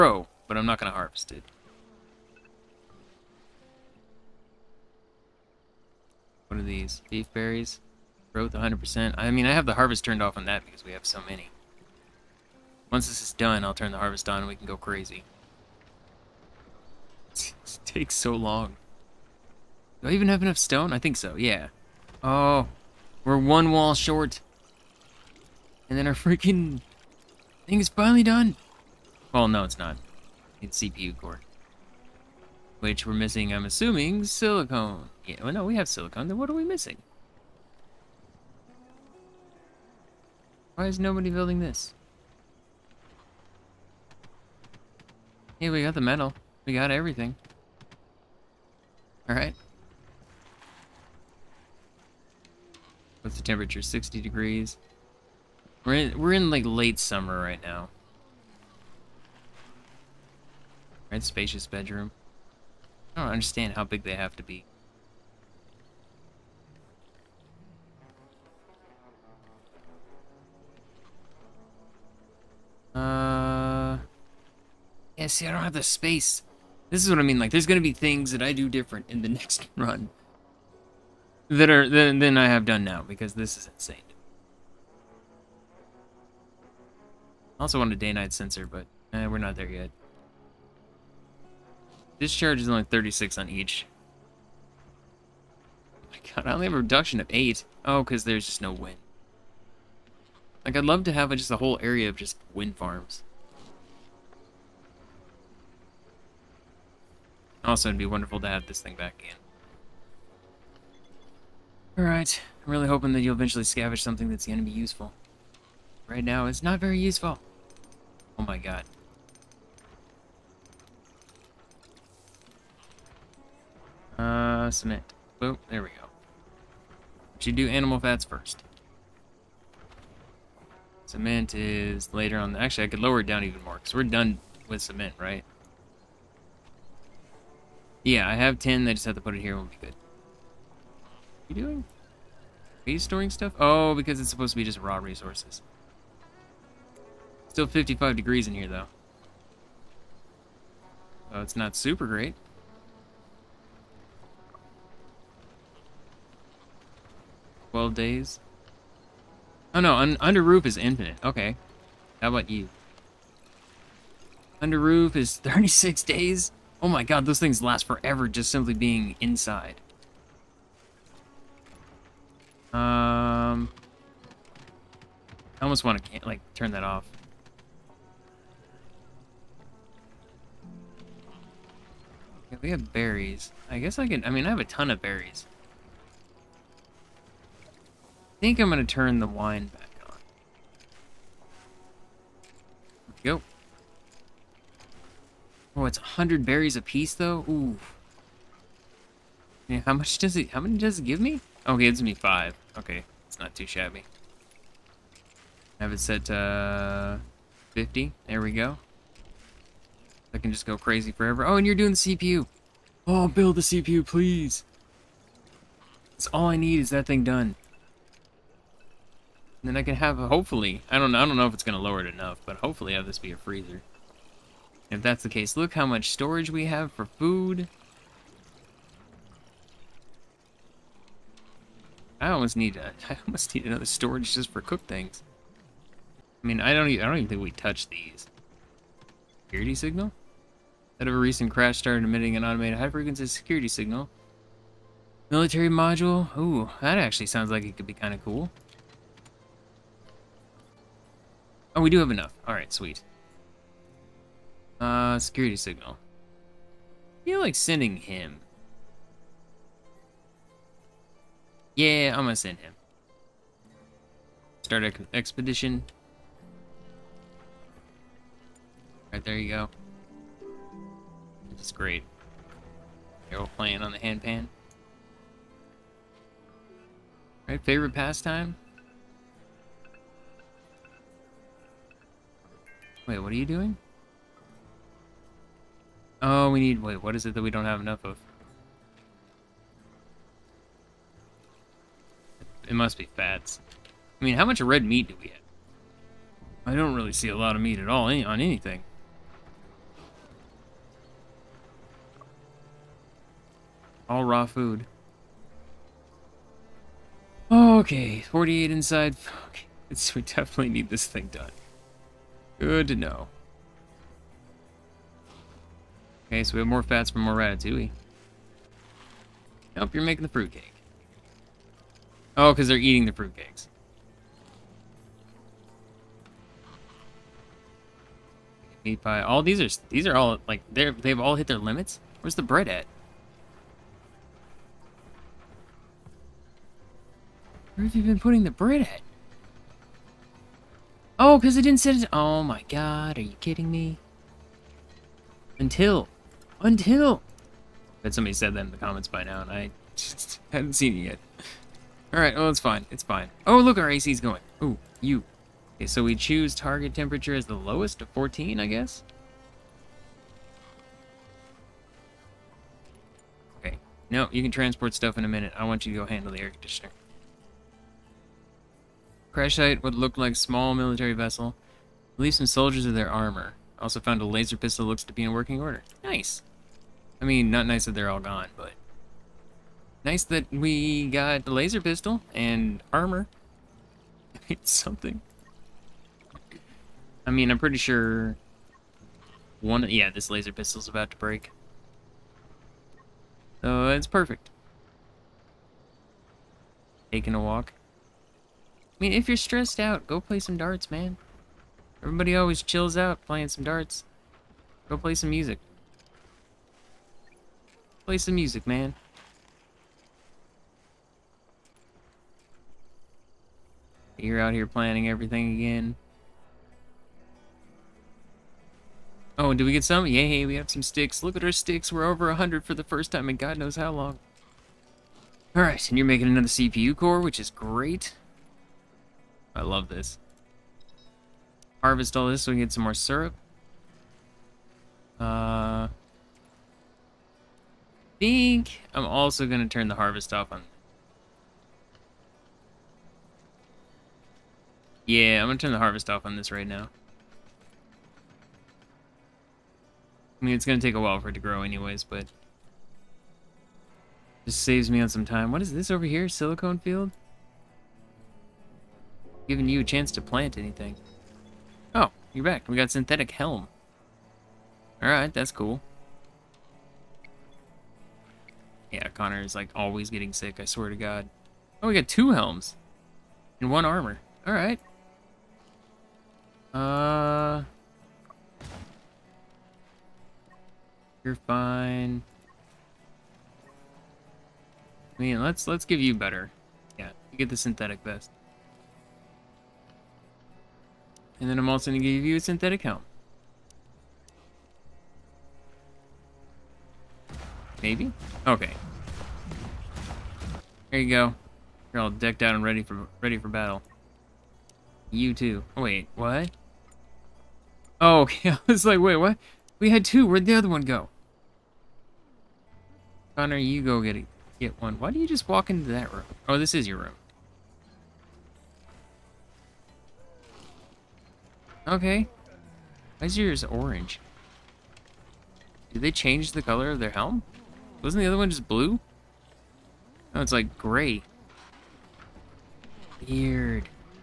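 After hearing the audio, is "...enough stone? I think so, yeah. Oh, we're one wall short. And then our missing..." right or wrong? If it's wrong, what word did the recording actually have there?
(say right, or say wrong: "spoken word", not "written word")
wrong: "freaking", not "missing".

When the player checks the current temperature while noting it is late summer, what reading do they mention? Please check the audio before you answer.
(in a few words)
60 degrees.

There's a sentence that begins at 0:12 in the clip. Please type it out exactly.
Once this is done, I'll turn the harvest on and we can go crazy.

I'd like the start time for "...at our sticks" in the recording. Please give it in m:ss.
7:01.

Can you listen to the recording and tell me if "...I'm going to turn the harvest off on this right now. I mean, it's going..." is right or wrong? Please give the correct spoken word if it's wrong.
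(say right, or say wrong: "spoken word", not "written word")
right.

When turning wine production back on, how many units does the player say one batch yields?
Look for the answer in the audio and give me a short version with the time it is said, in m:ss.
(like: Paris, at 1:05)
5, at 3:21.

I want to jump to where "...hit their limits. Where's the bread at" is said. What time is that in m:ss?
5:31.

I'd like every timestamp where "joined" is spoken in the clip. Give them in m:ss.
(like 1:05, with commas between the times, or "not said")
not said.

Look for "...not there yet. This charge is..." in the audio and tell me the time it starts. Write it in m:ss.
1:29.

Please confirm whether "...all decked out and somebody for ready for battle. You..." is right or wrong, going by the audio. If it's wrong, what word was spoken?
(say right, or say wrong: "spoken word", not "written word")
wrong: "ready", not "somebody".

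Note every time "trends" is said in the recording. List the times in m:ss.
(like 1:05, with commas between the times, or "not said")
not said.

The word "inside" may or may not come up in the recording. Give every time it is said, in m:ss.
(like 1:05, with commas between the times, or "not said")
2:49, 5:08.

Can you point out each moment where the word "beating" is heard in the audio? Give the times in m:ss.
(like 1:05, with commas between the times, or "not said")
not said.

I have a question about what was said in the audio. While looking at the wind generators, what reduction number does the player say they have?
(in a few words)
8.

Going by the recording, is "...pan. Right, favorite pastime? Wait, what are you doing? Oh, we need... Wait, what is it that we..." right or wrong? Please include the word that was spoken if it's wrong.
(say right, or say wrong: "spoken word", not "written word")
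right.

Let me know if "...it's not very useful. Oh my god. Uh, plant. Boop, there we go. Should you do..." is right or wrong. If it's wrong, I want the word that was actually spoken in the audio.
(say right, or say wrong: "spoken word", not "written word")
wrong: "cement", not "plant".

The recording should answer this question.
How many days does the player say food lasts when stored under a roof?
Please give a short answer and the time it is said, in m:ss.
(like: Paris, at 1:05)
36 days, at 2:45.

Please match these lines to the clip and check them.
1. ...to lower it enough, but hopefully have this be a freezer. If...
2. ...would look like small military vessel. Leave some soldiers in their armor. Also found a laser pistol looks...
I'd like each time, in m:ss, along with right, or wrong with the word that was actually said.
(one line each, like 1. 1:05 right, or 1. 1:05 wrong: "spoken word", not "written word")
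1. 3:41 right
2. 6:09 right.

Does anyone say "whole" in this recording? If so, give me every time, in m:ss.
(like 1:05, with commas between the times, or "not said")
1:41.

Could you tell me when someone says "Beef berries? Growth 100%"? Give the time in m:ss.
0:07.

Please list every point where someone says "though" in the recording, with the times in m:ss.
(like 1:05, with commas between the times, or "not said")
2:28, 3:17.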